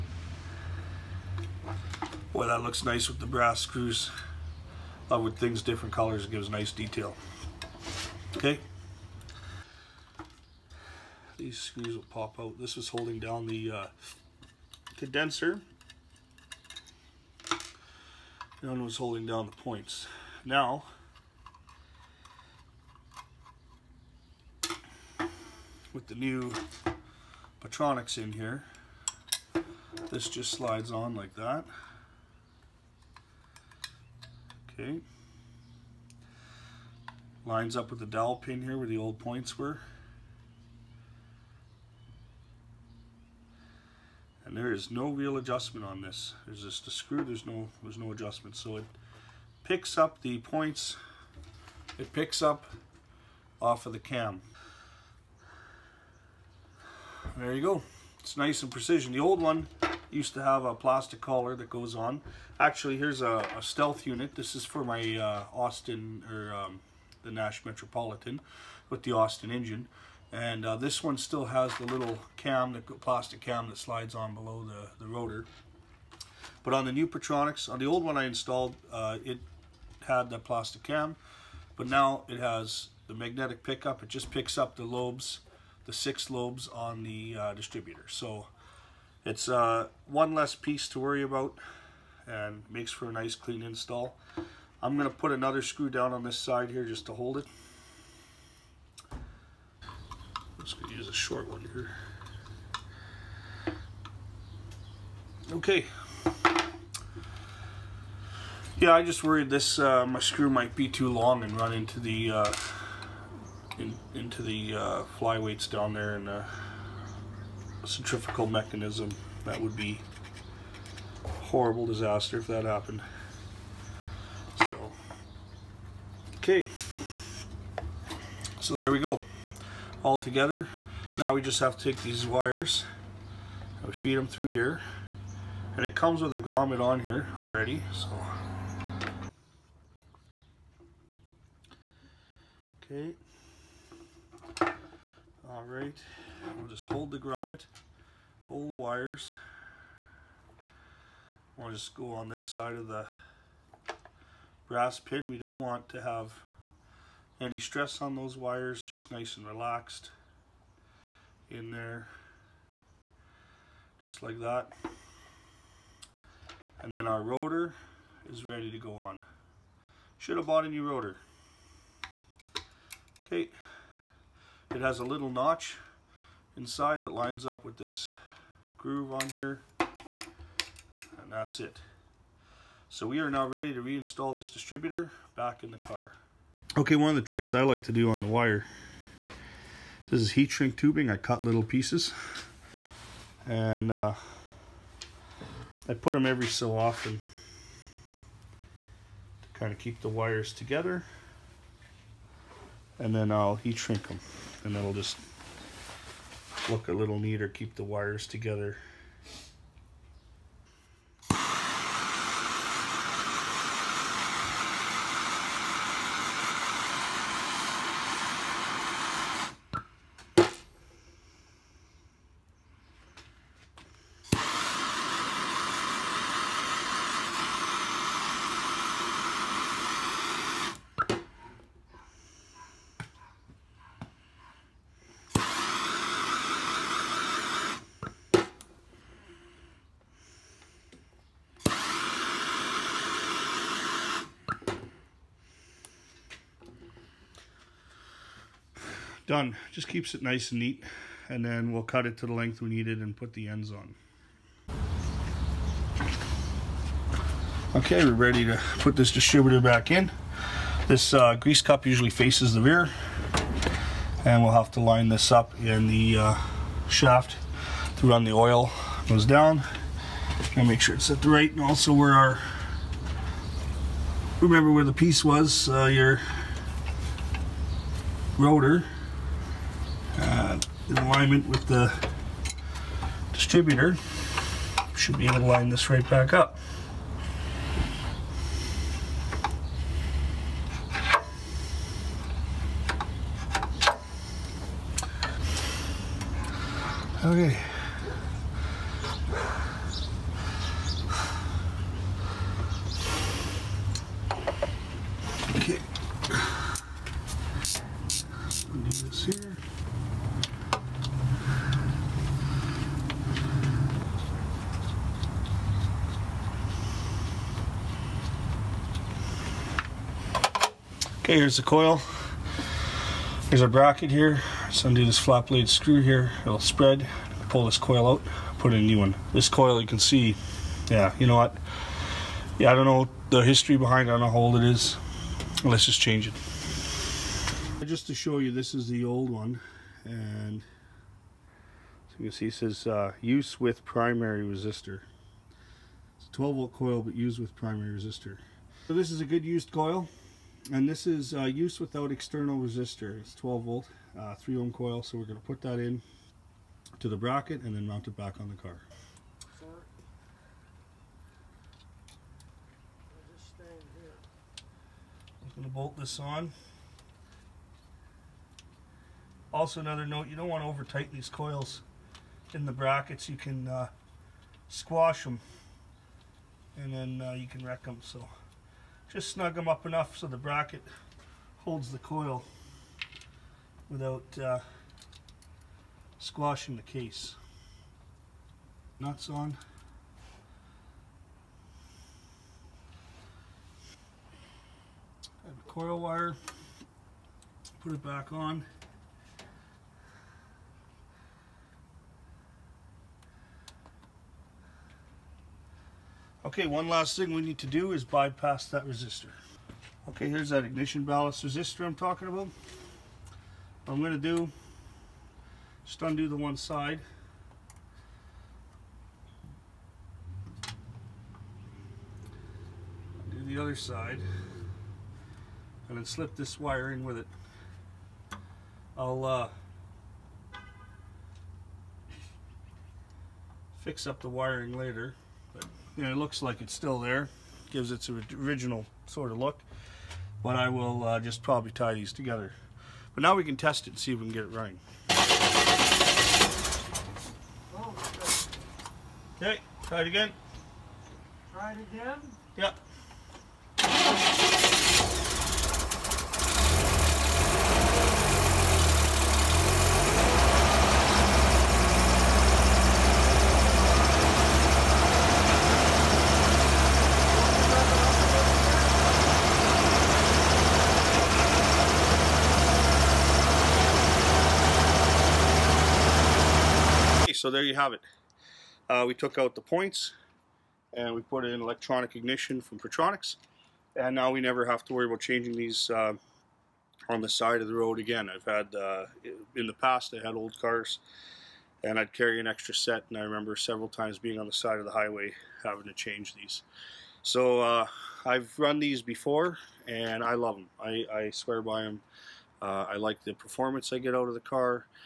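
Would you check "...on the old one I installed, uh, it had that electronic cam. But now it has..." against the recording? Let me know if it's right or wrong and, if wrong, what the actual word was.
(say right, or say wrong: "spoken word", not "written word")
wrong: "plastic", not "electronic".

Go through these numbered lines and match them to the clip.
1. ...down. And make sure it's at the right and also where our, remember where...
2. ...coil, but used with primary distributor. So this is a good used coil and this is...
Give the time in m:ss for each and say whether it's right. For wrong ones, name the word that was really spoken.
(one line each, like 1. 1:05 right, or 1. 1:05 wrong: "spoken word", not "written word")
1. 4:29 right
2. 5:46 wrong: "resistor", not "distributor".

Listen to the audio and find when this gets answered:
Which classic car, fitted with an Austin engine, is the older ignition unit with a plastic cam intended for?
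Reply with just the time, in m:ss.
1:07.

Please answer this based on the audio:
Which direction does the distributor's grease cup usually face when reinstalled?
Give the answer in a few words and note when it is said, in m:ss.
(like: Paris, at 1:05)
The rear, at 4:22.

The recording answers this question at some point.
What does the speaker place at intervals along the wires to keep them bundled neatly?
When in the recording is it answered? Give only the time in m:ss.
3:10.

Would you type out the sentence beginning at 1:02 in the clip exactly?
Actually, here's a, a stealth unit.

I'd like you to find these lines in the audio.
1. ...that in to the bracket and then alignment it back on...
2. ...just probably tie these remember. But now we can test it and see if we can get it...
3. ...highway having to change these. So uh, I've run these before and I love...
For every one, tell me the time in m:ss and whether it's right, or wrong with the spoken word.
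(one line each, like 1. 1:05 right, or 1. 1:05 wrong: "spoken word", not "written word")
1. 5:55 wrong: "mount", not "alignment"
2. 7:21 wrong: "together", not "remember"
3. 8:14 right.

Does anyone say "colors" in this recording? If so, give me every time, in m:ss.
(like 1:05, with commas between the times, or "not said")
0:05.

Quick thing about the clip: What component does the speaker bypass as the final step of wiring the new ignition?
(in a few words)
Ignition ballast resistor.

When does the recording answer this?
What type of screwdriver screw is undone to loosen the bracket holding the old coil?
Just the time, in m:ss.
5:25.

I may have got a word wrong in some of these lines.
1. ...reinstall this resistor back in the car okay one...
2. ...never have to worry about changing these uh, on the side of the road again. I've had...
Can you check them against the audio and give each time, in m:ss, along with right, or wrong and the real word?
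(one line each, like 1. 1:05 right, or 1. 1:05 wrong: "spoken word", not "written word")
1. 3:03 wrong: "distributor", not "resistor"
2. 8:04 right.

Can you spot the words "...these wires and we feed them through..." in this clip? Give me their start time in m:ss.
2:12.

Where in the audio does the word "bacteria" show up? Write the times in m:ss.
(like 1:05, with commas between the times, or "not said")
not said.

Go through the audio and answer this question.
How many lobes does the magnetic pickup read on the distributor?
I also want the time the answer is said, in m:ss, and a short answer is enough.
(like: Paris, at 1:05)
6, at 1:25.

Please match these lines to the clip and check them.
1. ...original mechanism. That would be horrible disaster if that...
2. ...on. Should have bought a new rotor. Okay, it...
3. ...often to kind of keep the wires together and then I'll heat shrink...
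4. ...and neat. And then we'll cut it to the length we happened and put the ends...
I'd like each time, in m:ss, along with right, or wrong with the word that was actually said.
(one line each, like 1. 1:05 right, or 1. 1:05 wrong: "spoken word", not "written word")
1. 1:57 wrong: "centrifugal", not "original"
2. 2:48 right
3. 3:16 right
4. 4:10 wrong: "needed", not "happened".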